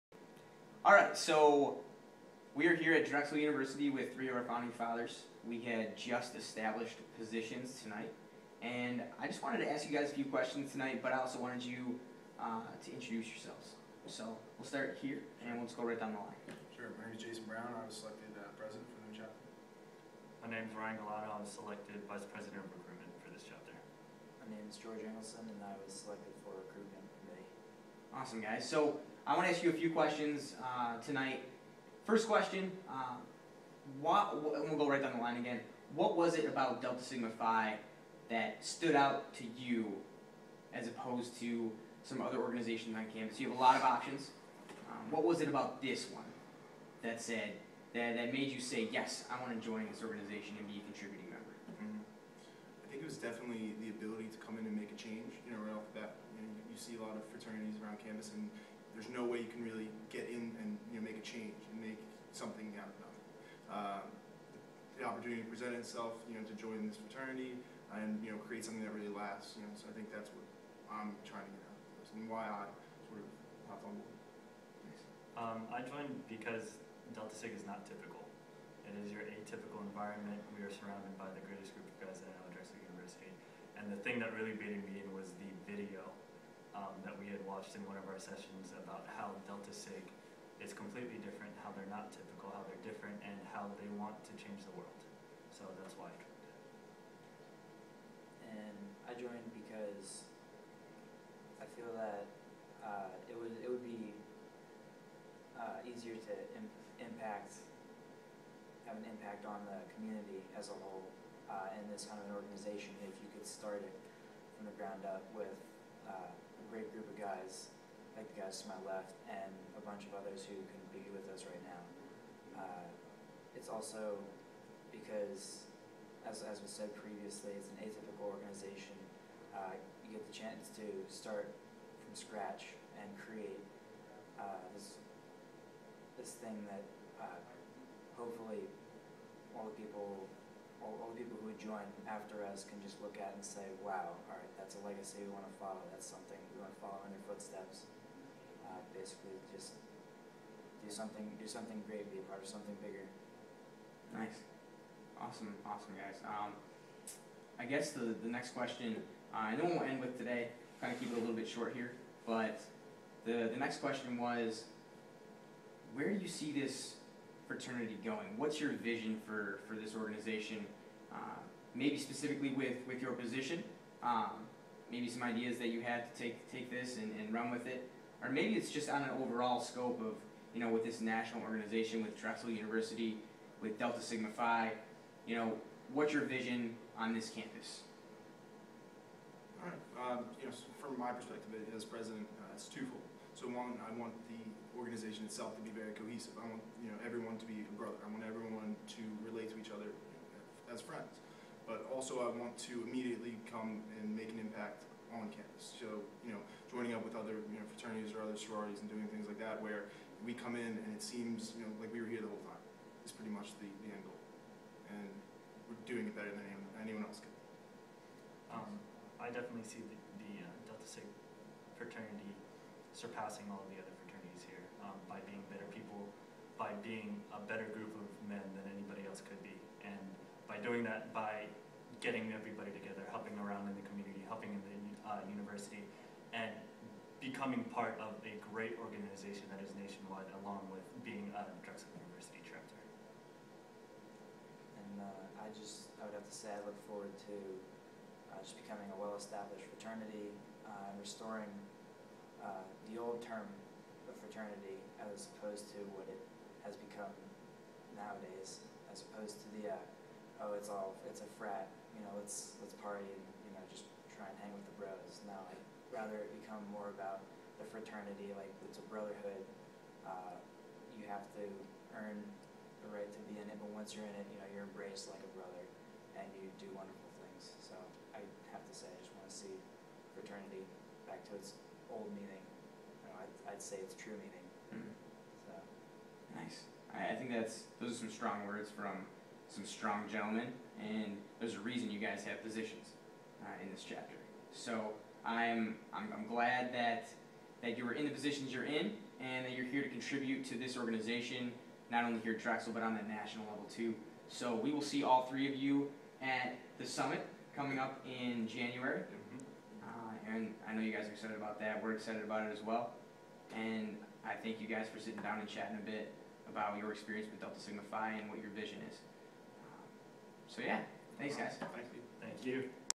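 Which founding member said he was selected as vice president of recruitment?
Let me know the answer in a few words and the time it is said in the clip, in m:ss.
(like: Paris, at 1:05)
Ryan Galata, at 0:20.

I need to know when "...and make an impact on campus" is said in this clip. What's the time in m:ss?
3:23.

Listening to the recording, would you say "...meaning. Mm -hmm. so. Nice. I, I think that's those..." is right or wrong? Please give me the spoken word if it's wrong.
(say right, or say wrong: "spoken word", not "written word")
right.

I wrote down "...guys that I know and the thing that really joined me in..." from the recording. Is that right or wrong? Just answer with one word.
wrong.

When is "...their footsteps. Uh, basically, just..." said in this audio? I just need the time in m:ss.
2:27.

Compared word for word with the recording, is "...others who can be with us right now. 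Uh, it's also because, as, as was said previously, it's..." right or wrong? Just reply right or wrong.
right.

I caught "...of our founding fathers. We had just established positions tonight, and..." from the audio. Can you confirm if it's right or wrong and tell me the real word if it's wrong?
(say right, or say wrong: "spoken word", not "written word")
right.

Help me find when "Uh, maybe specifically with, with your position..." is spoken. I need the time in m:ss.
2:51.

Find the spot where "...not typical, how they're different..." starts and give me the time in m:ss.
1:31.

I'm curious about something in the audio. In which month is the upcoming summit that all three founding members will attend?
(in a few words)
January.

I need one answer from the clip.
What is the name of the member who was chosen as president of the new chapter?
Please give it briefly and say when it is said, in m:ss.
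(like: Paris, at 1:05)
Jason Brown, at 0:17.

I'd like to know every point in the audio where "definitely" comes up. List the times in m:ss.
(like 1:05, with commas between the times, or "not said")
0:53, 3:39.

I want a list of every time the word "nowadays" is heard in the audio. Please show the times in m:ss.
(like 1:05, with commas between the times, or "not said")
4:17.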